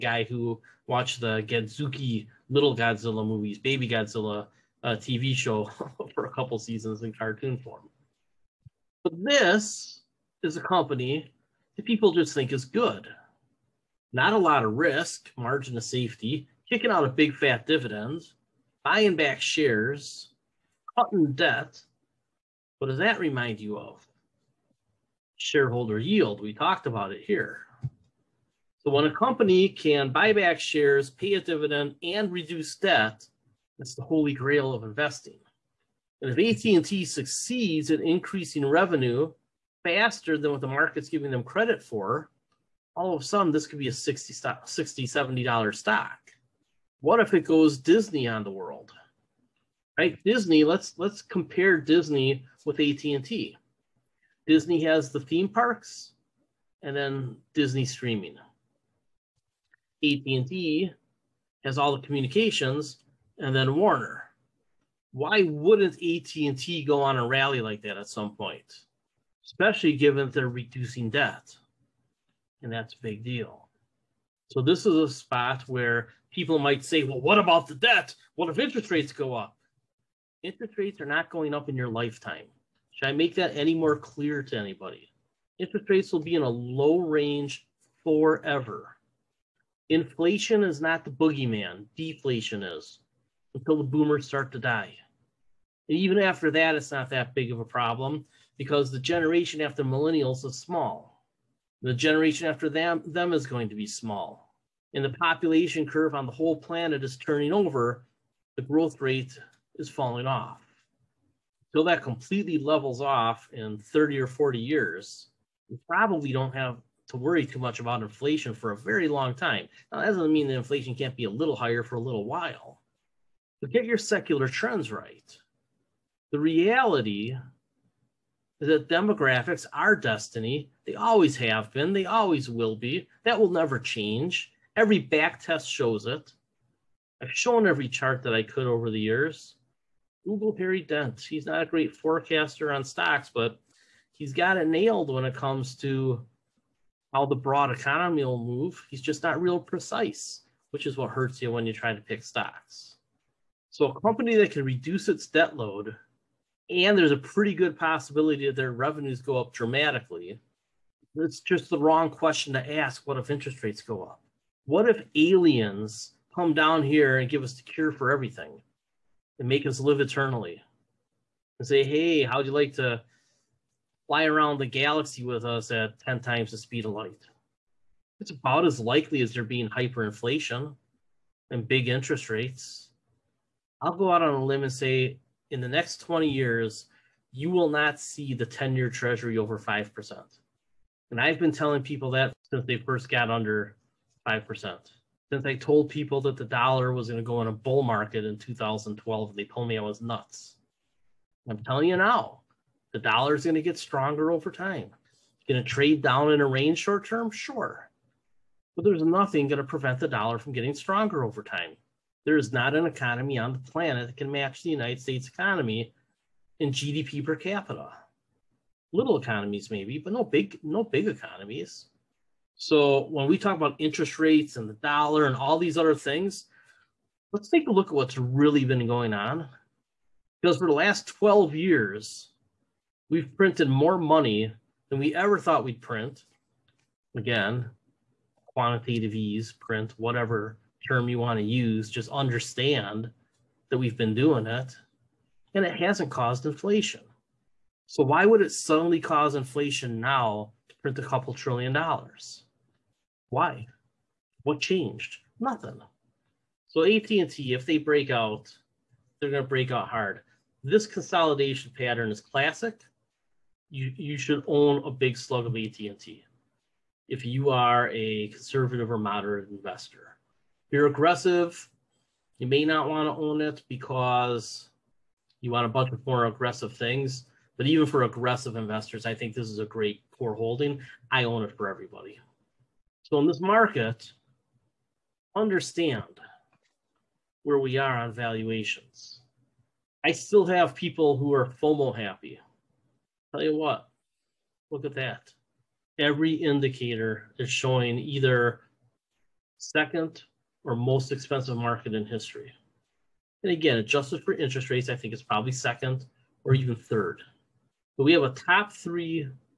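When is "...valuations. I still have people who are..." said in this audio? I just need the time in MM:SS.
04:48.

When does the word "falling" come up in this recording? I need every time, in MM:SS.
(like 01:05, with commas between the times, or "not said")
01:49.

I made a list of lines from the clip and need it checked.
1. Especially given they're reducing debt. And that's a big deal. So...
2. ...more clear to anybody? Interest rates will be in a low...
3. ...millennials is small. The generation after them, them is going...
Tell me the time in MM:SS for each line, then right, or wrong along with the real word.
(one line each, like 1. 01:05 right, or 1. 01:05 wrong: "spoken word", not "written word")
1. 01:09 right
2. 01:23 right
3. 01:39 right.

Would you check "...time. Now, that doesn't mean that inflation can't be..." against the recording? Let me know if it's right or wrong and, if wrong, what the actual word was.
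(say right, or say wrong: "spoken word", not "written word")
right.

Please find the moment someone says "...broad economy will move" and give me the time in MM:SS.
02:27.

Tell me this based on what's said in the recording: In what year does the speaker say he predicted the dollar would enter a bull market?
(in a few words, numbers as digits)
2012.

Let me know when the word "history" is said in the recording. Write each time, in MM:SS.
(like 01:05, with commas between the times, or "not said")
05:02.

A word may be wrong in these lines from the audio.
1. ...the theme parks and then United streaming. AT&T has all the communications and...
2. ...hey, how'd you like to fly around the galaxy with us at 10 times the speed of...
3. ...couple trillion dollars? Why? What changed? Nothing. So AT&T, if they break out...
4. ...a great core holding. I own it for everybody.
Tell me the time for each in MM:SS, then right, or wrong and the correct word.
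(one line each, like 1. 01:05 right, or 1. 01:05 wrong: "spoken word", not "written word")
1. 00:55 wrong: "Disney", not "United"
2. 02:51 right
3. 04:11 right
4. 04:39 right.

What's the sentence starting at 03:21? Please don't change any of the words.
I'm telling you now, the dollar is going to get stronger over time.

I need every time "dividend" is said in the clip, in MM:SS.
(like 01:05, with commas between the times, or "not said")
00:17, 00:31.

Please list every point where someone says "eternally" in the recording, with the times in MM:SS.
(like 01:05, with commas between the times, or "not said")
02:50.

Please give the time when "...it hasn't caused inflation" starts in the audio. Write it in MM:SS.
04:05.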